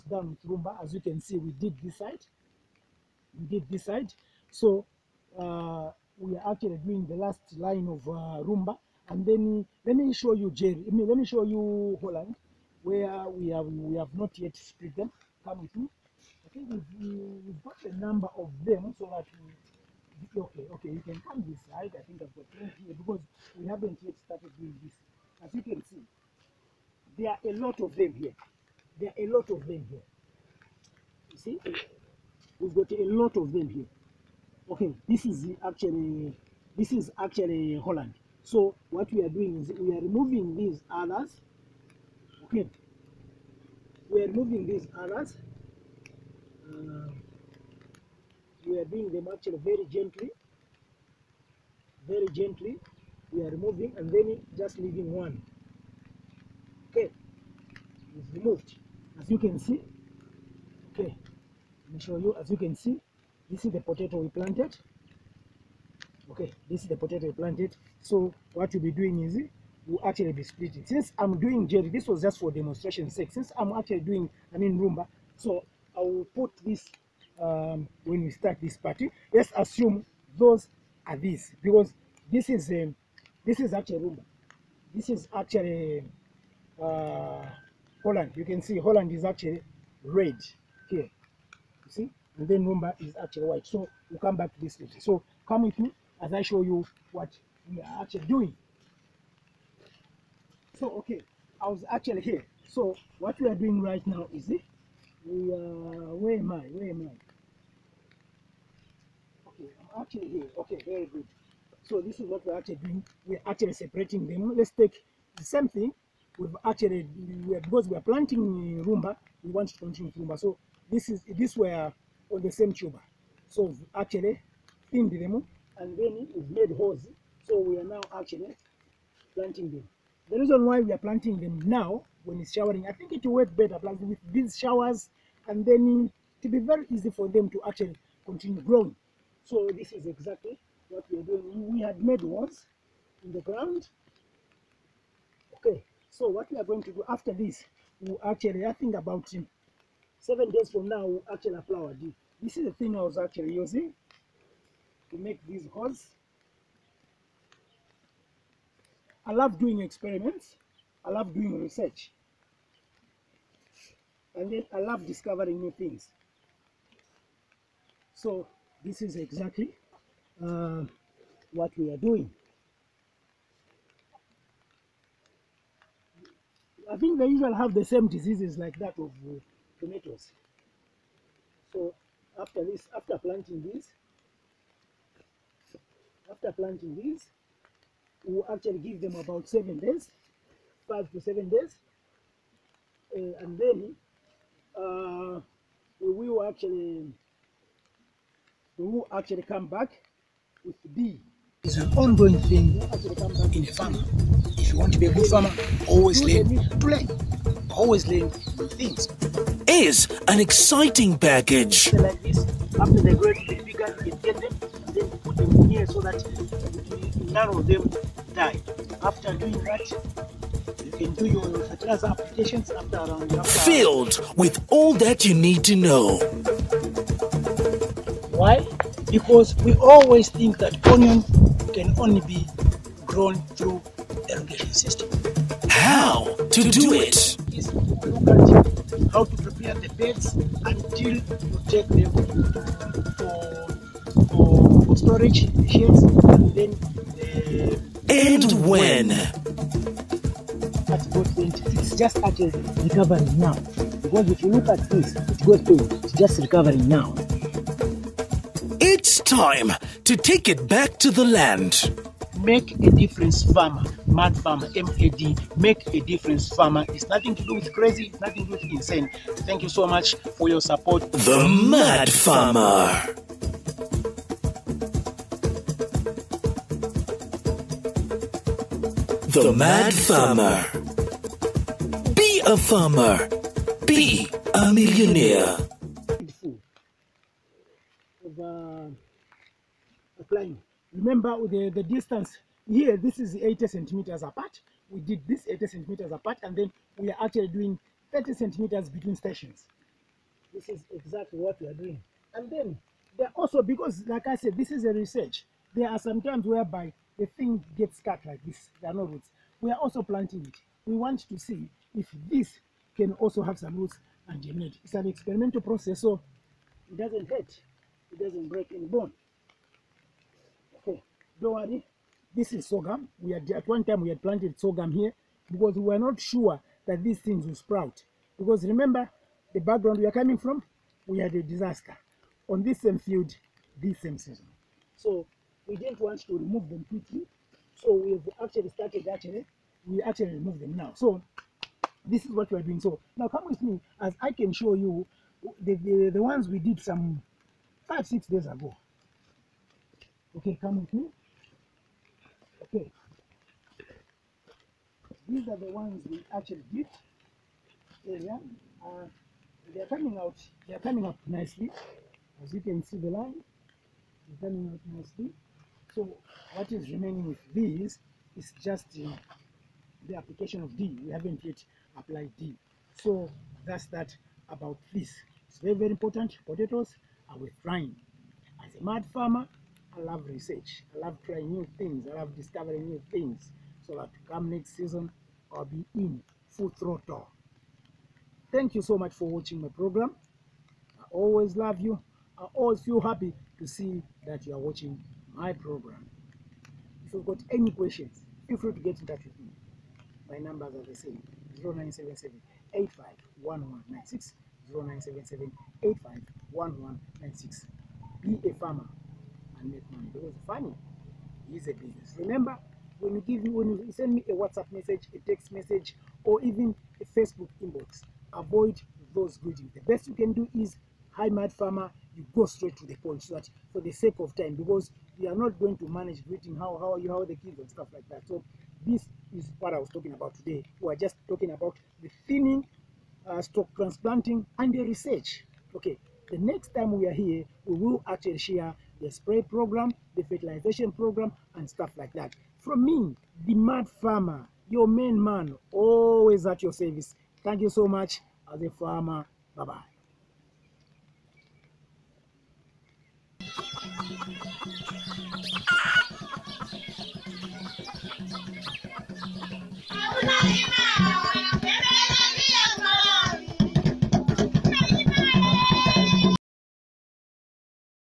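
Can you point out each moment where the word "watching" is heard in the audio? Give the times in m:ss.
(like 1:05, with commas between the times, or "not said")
6:29, 6:34.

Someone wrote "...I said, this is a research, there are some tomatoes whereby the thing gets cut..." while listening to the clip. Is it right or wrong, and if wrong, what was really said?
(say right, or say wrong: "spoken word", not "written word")
wrong: "times", not "tomatoes".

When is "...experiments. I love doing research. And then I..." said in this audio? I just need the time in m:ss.
2:39.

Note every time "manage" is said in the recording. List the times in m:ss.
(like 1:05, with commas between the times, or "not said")
7:05.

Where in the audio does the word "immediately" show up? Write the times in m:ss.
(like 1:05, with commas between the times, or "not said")
not said.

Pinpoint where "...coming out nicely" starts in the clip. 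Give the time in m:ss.
6:04.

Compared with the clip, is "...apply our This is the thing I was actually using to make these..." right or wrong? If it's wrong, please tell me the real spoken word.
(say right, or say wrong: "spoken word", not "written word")
right.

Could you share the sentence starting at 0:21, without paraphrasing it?
I think I've got things here because we haven't yet started doing this.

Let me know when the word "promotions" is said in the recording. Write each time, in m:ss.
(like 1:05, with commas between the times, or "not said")
not said.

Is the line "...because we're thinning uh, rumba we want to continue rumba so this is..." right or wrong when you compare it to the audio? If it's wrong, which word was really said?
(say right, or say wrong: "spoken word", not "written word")
wrong: "planting", not "thinning".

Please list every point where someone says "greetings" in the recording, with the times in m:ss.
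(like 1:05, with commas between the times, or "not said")
6:59, 7:06.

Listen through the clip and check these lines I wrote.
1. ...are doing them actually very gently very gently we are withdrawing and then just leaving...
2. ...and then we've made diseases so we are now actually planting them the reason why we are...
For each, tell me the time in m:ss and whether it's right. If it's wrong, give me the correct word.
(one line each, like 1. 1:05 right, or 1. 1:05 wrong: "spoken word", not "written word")
1. 0:48 wrong: "removing", not "withdrawing"
2. 2:05 wrong: "holes", not "diseases".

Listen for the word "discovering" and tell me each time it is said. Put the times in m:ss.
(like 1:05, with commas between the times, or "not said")
2:45, 6:22.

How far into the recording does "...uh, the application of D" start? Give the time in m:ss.
6:09.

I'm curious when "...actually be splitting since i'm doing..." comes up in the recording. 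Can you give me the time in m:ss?
1:10.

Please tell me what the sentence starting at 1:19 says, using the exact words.
Let's assume those are these because this is a, um, this is actually Roma.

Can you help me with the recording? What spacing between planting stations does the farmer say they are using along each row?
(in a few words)
30 centimeters.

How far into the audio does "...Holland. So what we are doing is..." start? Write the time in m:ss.
0:37.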